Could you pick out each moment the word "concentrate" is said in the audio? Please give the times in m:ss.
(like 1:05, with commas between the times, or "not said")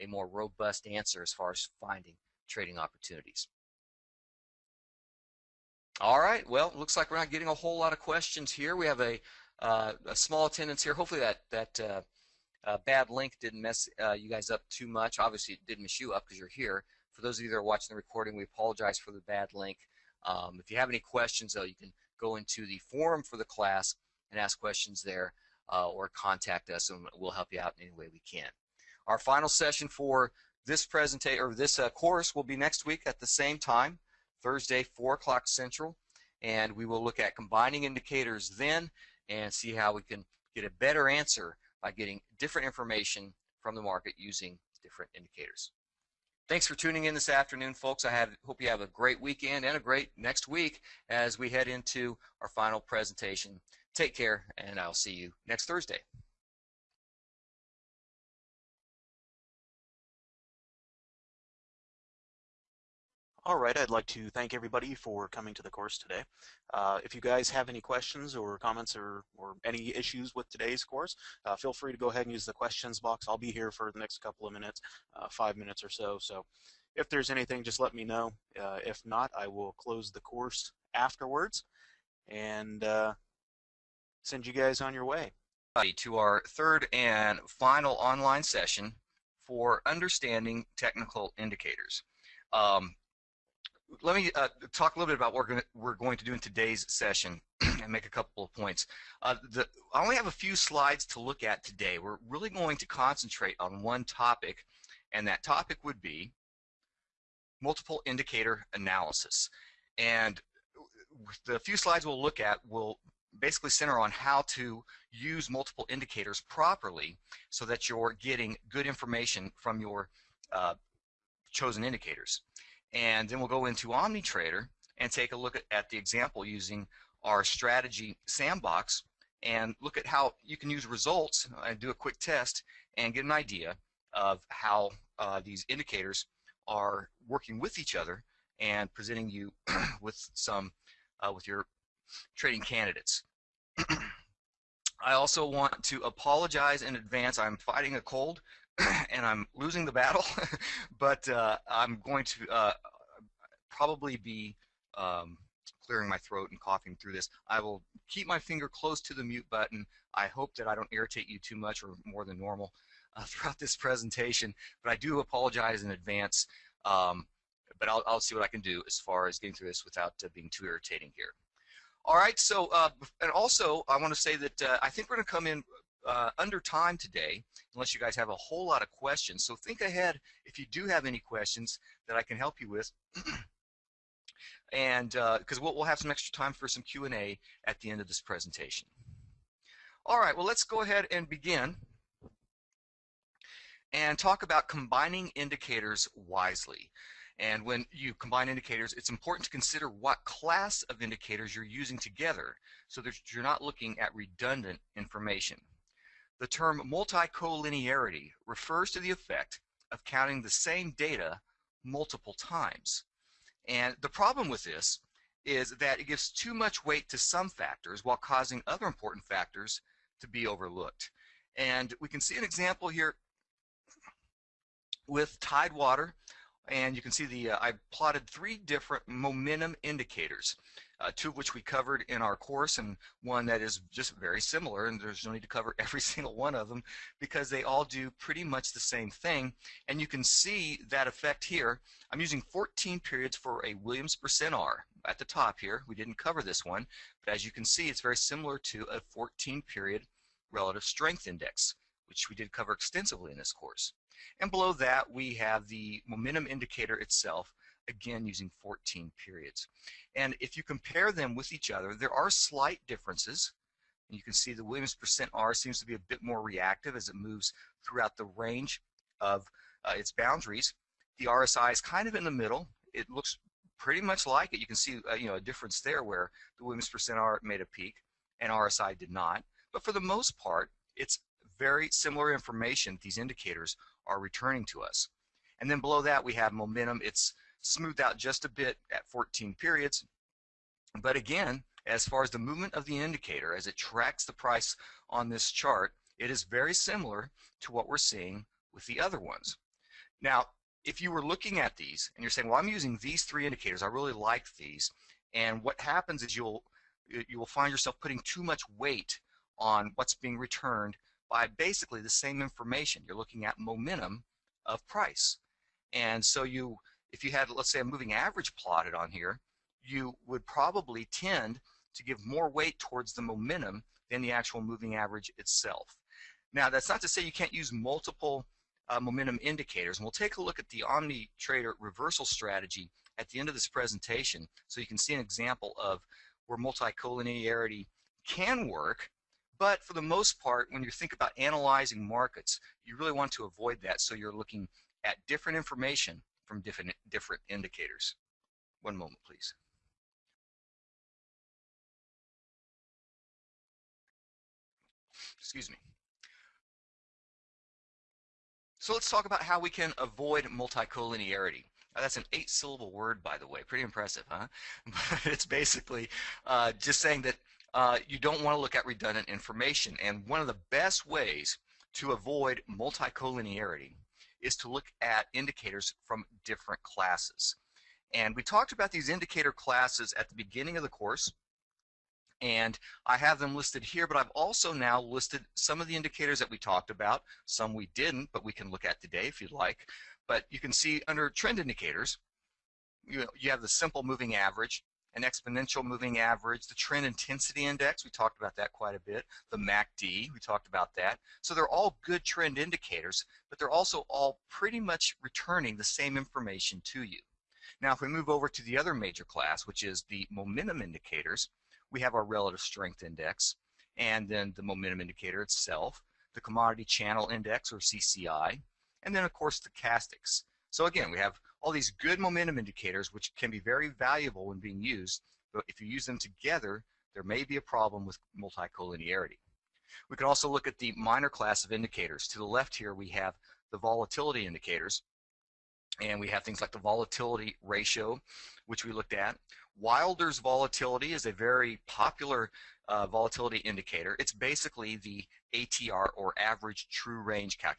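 1:42.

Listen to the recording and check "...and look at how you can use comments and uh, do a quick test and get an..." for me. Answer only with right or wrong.
wrong.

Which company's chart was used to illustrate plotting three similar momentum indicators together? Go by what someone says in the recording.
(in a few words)
Tidewater.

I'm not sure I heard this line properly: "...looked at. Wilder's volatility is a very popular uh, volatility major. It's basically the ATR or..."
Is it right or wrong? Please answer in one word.
wrong.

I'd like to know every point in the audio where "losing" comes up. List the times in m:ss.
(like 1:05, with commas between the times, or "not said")
2:29.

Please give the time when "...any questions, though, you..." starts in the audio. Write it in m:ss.
0:20.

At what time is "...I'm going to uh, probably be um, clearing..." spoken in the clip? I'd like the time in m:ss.
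2:31.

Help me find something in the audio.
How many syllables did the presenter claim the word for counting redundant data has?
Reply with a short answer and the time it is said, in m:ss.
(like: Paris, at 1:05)
8, at 6:02.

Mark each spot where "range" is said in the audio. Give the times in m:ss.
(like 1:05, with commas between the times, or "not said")
4:28, 7:27.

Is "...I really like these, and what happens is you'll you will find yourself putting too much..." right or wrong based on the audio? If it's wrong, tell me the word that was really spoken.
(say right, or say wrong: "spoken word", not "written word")
right.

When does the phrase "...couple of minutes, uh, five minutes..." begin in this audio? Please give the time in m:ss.
1:14.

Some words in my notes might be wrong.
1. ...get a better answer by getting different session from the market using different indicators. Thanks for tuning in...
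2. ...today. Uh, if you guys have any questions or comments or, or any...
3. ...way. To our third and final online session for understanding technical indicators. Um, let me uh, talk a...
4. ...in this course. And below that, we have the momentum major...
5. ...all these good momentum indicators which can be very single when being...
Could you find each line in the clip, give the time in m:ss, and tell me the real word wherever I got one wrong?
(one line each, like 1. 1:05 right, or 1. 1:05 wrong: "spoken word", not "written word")
1. 0:40 wrong: "information", not "session"
2. 1:05 right
3. 1:25 right
4. 4:13 wrong: "indicator", not "major"
5. 7:01 wrong: "valuable", not "single".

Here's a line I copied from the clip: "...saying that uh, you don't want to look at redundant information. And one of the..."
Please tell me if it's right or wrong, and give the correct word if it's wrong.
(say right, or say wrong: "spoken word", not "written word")
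right.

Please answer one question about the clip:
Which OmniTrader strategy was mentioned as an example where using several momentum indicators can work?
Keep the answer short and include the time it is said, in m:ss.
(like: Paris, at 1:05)
reversal strategy, at 5:31.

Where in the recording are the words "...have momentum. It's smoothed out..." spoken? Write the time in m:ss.
4:46.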